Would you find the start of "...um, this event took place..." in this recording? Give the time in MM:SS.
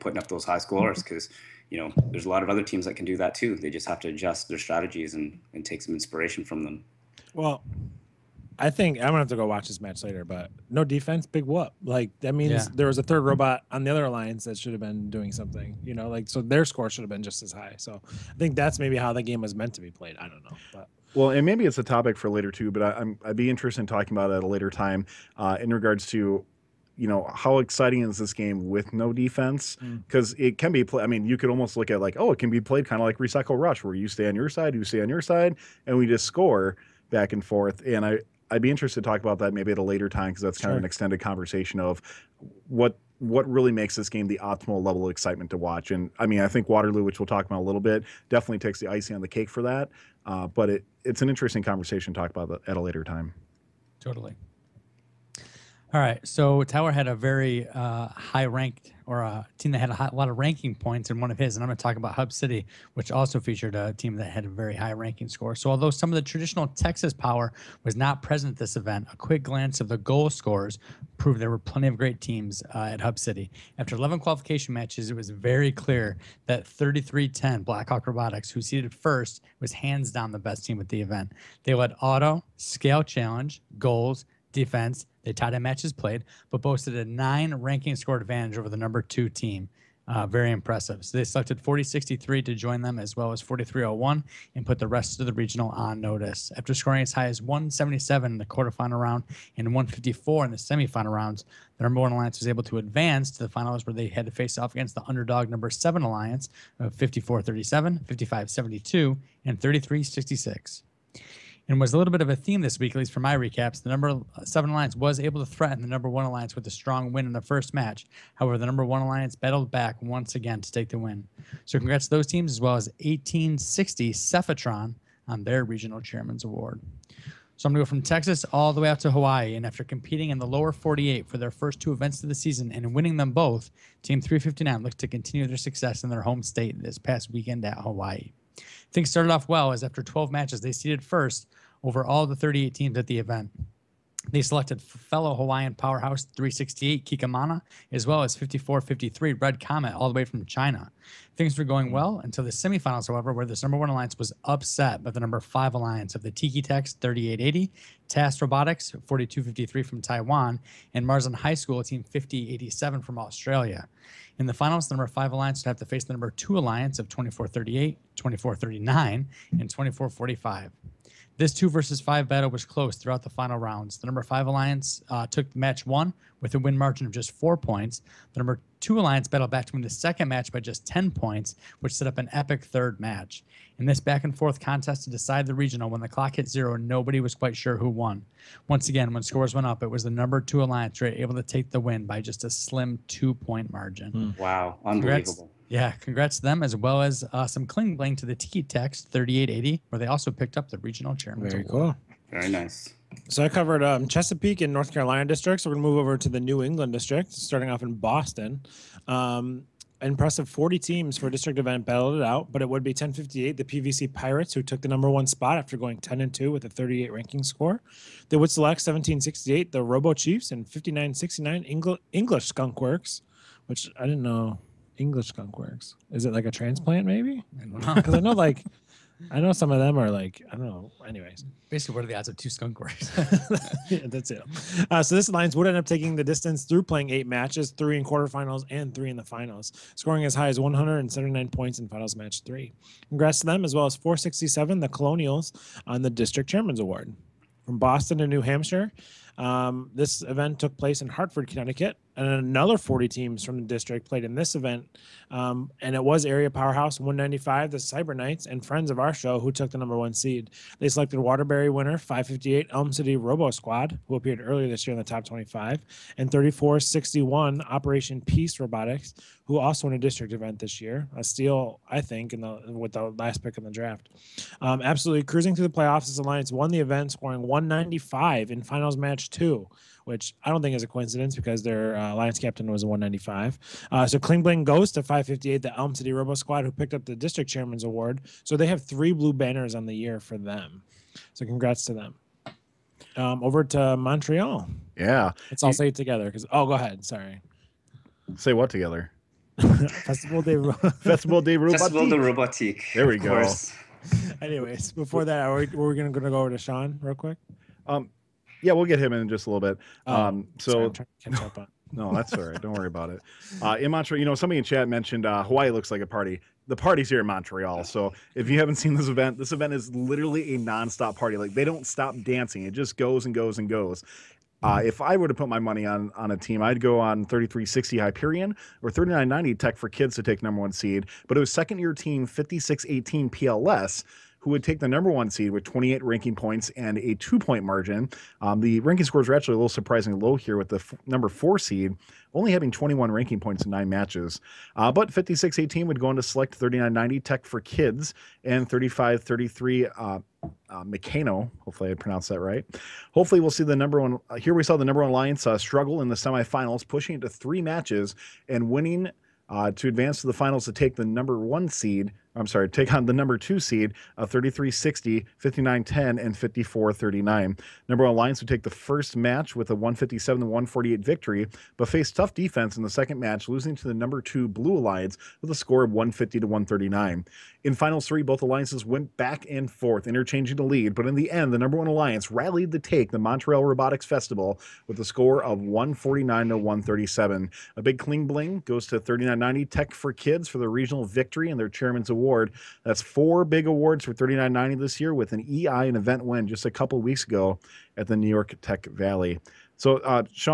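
04:09.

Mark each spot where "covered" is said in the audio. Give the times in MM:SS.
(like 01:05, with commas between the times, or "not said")
03:23.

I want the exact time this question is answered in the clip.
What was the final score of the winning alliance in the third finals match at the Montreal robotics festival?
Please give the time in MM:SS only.
06:25.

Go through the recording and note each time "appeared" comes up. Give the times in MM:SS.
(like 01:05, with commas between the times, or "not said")
04:24.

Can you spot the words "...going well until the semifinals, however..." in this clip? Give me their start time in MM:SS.
02:31.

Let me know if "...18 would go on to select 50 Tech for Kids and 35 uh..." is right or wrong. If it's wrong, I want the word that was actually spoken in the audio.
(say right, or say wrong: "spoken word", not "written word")
wrong: "90", not "50".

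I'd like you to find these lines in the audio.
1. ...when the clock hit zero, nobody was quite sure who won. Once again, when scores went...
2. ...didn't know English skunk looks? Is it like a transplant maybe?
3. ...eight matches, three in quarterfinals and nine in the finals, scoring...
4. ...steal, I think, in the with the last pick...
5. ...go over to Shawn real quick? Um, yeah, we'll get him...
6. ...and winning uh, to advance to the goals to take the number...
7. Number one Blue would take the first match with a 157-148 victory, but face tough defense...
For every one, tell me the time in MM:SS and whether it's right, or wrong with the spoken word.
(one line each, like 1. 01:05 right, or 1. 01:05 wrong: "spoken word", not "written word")
1. 03:05 right
2. 03:44 wrong: "works", not "looks"
3. 03:57 wrong: "three", not "nine"
4. 04:31 right
5. 05:06 right
6. 05:58 wrong: "finals", not "goals"
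7. 06:07 wrong: "Lions", not "Blue".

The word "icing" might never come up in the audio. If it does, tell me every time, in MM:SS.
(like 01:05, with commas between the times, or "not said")
00:48.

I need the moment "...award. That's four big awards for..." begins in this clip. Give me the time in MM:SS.
06:32.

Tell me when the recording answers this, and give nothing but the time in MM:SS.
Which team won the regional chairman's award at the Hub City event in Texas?
02:03.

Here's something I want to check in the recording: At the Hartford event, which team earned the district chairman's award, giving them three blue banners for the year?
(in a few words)
558 Elm City Robo Squad.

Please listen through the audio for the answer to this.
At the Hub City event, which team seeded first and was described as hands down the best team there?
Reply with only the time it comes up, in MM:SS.
01:16.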